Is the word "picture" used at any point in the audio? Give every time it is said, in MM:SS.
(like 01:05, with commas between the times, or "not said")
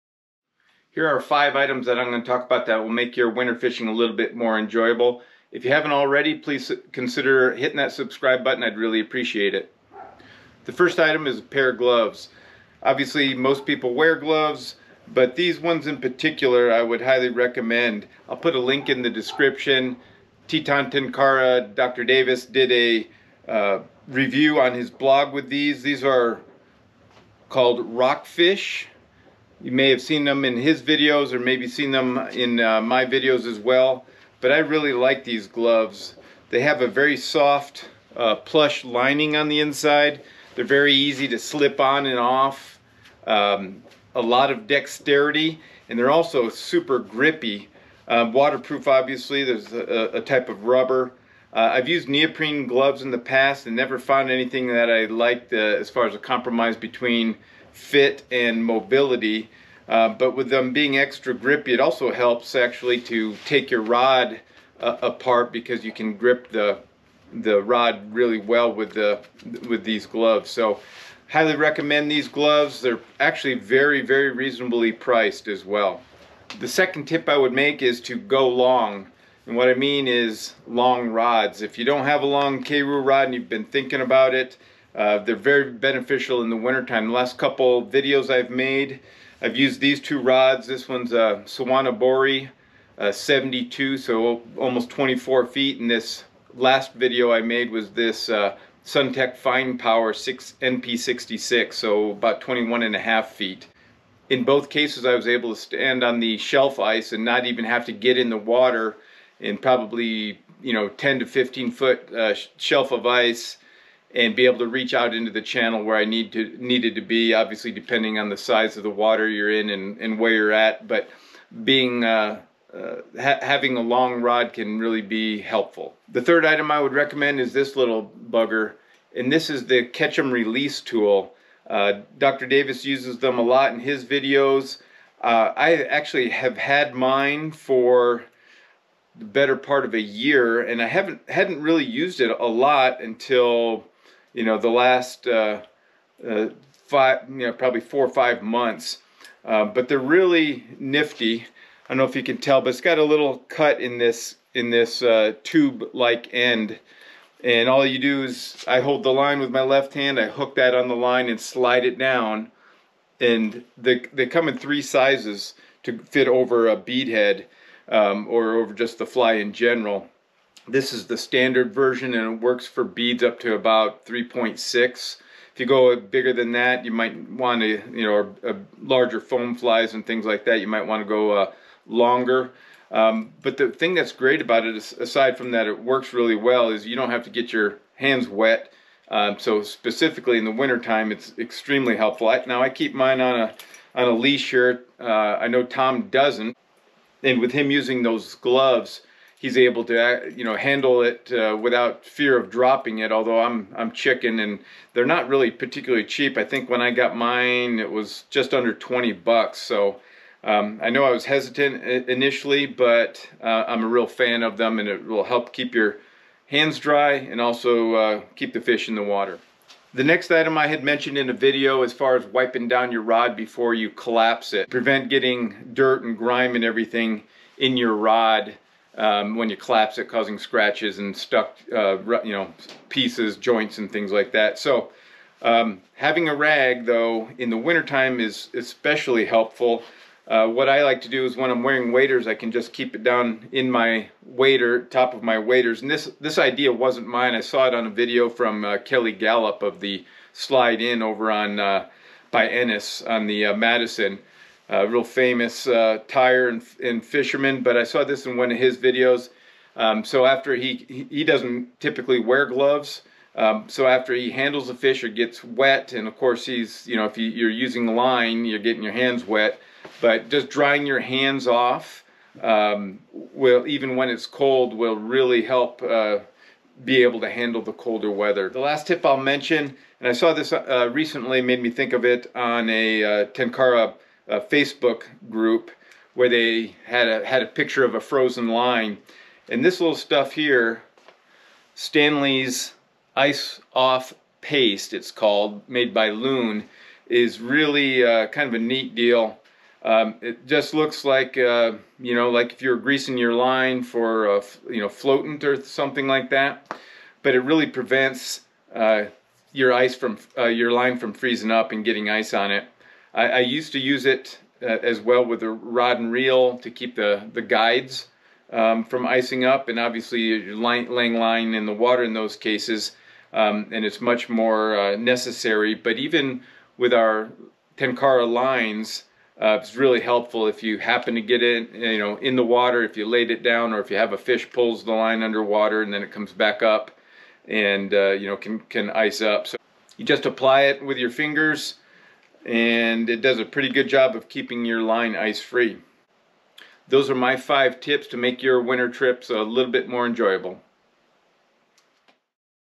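04:47.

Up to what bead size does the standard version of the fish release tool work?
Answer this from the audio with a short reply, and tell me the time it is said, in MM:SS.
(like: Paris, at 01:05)
3.6, at 02:54.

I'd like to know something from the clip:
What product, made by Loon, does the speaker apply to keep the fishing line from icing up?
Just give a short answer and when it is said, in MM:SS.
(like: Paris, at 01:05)
Stanley's Ice Off Paste, at 04:51.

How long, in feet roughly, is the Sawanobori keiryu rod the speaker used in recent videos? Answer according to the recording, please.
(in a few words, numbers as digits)
almost 24 feet.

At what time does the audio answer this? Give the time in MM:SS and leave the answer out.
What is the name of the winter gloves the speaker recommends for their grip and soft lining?
00:27.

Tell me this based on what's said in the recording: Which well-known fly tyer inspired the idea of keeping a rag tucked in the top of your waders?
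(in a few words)
Kelly Galloup.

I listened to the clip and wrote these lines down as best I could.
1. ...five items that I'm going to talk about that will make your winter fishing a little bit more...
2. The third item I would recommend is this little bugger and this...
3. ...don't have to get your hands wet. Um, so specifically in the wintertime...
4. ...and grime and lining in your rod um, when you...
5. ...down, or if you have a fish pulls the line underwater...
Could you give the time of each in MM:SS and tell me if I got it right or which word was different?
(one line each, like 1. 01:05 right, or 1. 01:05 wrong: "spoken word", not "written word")
1. 00:01 right
2. 02:06 right
3. 03:06 right
4. 03:46 wrong: "everything", not "lining"
5. 05:33 right.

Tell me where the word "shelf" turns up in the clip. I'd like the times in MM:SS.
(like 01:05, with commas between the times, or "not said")
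01:46, 01:52.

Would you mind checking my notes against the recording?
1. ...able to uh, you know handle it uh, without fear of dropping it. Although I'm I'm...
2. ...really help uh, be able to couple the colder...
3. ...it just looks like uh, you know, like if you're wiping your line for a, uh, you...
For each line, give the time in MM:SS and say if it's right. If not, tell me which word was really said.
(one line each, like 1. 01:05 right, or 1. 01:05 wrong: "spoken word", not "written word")
1. 03:19 right
2. 04:34 wrong: "handle", not "couple"
3. 05:00 wrong: "greasing", not "wiping".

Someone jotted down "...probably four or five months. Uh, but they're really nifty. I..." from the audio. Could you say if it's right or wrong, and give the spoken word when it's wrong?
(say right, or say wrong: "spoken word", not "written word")
right.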